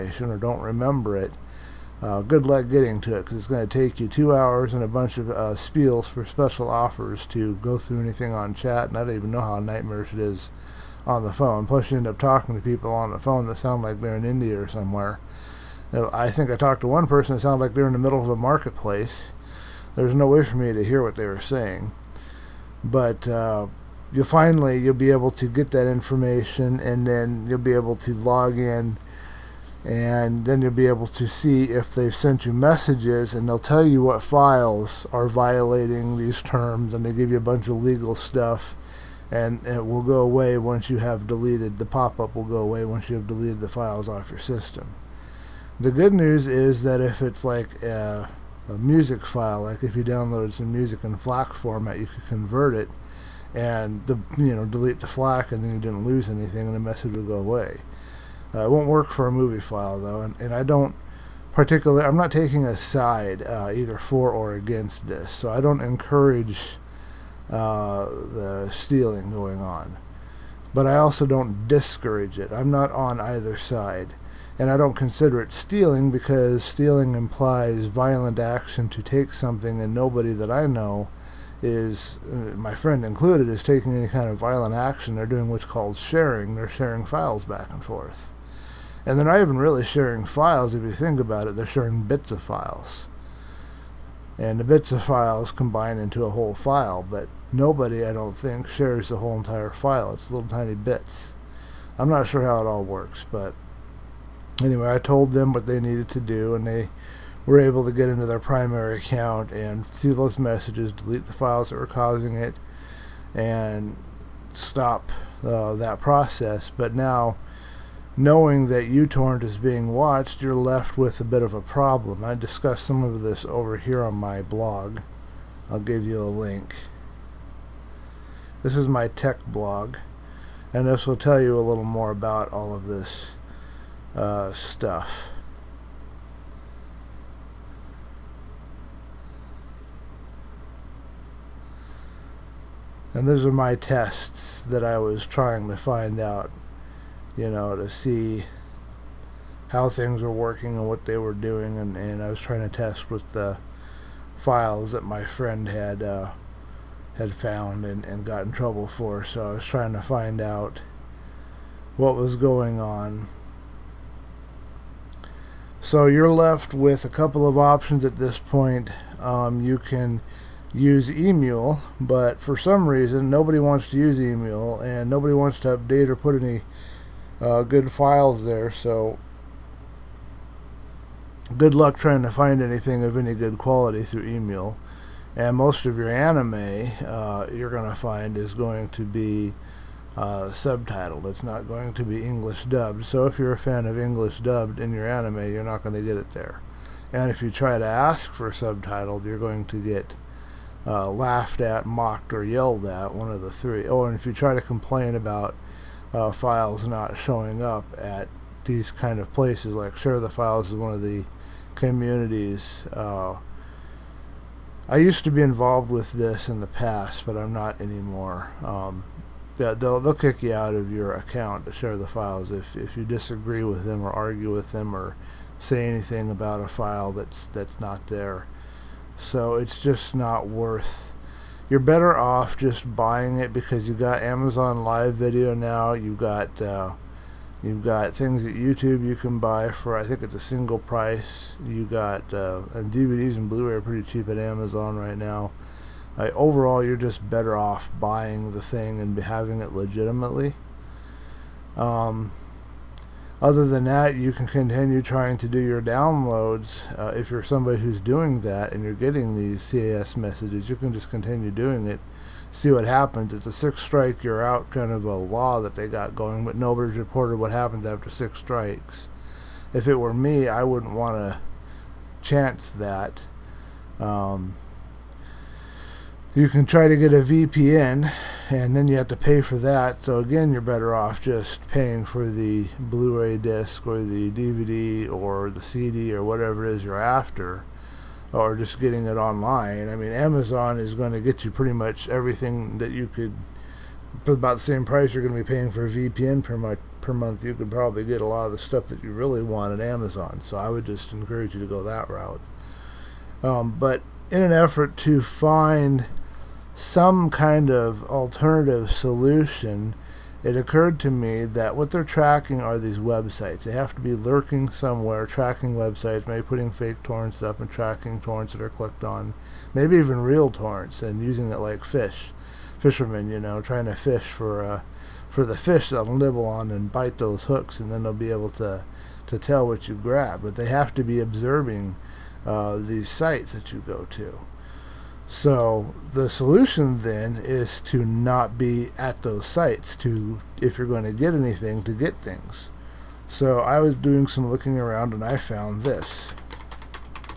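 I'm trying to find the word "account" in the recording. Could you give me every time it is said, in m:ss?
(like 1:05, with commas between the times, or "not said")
1:48, 3:41.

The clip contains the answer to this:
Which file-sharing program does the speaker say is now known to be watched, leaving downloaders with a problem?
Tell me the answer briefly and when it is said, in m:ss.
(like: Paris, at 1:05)
uTorrent, at 1:58.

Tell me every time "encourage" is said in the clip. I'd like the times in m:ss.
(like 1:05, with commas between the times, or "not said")
1:05, 5:01.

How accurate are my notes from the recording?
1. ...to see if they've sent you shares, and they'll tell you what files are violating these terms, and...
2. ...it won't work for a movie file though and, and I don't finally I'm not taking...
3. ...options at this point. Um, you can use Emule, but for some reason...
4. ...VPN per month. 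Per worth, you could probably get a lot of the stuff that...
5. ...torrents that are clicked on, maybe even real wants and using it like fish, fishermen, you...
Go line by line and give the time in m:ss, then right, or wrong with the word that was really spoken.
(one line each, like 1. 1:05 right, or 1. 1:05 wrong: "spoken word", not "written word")
1. 0:31 wrong: "messages", not "shares"
2. 0:58 wrong: "particularly", not "finally"
3. 2:47 right
4. 4:55 wrong: "month", not "worth"
5. 5:18 wrong: "torrents", not "wants".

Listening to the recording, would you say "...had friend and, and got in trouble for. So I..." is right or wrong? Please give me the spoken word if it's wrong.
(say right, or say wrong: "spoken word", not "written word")
wrong: "found", not "friend".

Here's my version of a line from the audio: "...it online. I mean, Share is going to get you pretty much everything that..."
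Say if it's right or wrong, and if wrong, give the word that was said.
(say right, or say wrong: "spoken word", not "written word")
wrong: "Amazon", not "Share".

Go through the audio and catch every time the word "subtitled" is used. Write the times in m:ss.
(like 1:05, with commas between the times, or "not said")
3:10, 3:18.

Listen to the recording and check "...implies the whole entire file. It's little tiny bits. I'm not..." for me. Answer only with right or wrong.
wrong.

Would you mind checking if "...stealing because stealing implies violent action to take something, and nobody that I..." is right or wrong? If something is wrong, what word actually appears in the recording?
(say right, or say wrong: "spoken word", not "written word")
right.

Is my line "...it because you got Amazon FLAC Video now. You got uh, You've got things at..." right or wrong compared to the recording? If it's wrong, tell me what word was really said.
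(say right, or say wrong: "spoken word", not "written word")
wrong: "Live", not "FLAC".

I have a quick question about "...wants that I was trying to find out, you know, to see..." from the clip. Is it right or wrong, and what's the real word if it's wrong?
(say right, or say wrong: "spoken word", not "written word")
wrong: "tests", not "wants".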